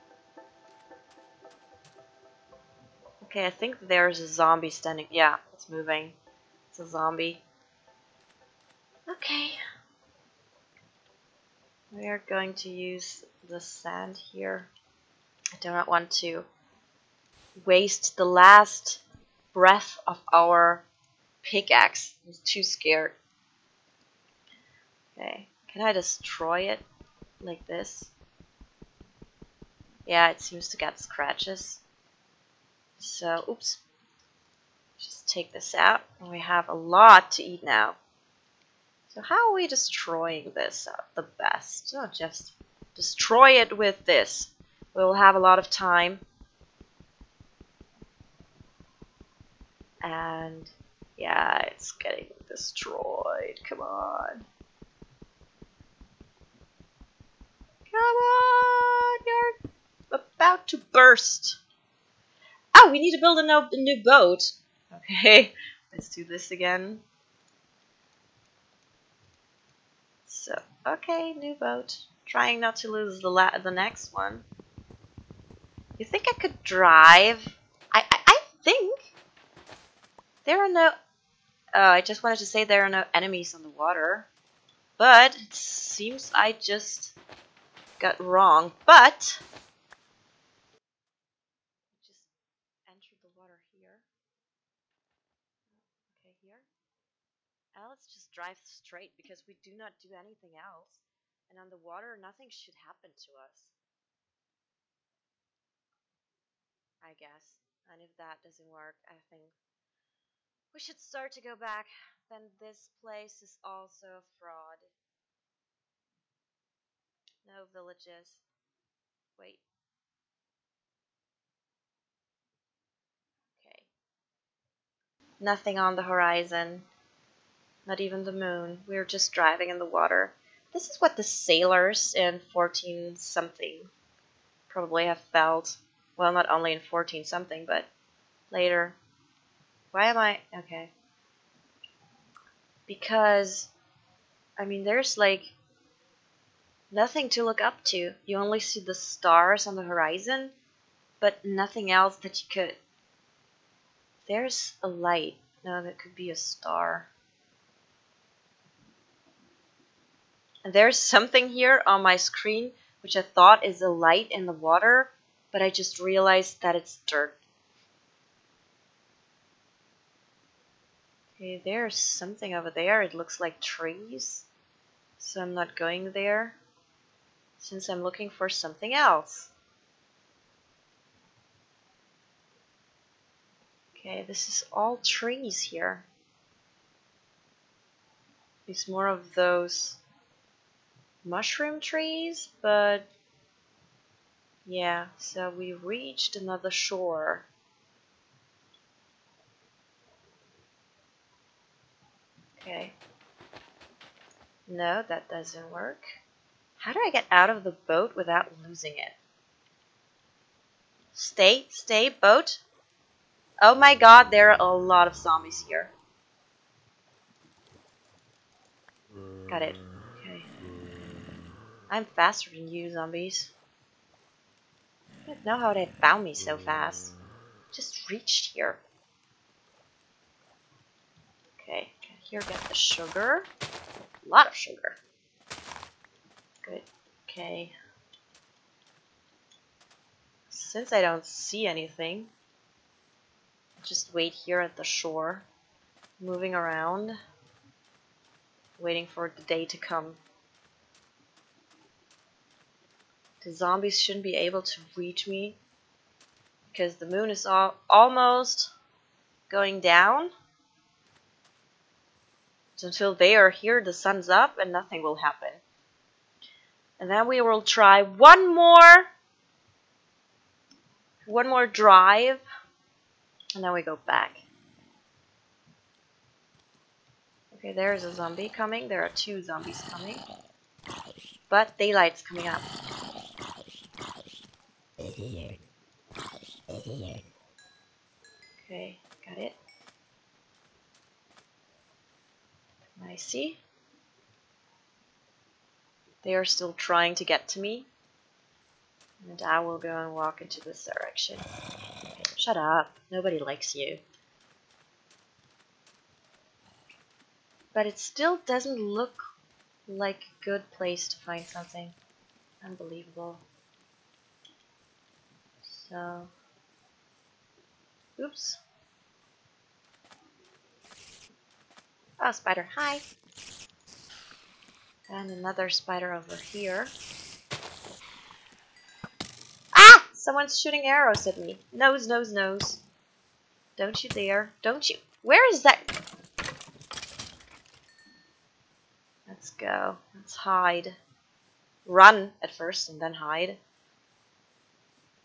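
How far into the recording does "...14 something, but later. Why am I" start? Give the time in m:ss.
2:16.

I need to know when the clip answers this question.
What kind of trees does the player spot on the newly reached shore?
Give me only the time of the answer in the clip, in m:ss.
3:11.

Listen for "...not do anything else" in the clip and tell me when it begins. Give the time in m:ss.
1:39.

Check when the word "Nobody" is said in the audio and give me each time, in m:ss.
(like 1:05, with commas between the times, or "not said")
5:03.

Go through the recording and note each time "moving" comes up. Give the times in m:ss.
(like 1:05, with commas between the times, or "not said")
0:05, 4:06.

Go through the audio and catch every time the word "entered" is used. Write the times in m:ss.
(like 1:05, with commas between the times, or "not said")
1:32.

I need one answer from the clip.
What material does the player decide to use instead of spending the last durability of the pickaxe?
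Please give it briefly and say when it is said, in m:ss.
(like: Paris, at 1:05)
sand, at 0:13.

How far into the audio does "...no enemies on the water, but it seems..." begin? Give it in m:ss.
1:22.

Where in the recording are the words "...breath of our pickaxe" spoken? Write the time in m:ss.
0:19.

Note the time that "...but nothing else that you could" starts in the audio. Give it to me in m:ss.
2:31.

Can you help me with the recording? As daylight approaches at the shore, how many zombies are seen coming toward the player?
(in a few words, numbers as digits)
2.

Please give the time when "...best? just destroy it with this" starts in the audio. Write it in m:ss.
0:41.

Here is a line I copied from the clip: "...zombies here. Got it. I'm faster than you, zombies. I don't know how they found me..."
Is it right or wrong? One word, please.
right.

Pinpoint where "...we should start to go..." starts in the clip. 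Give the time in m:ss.
1:50.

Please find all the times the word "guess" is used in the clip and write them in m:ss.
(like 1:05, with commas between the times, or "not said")
1:47.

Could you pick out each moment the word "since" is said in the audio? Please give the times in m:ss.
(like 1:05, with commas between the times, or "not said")
2:57, 4:00.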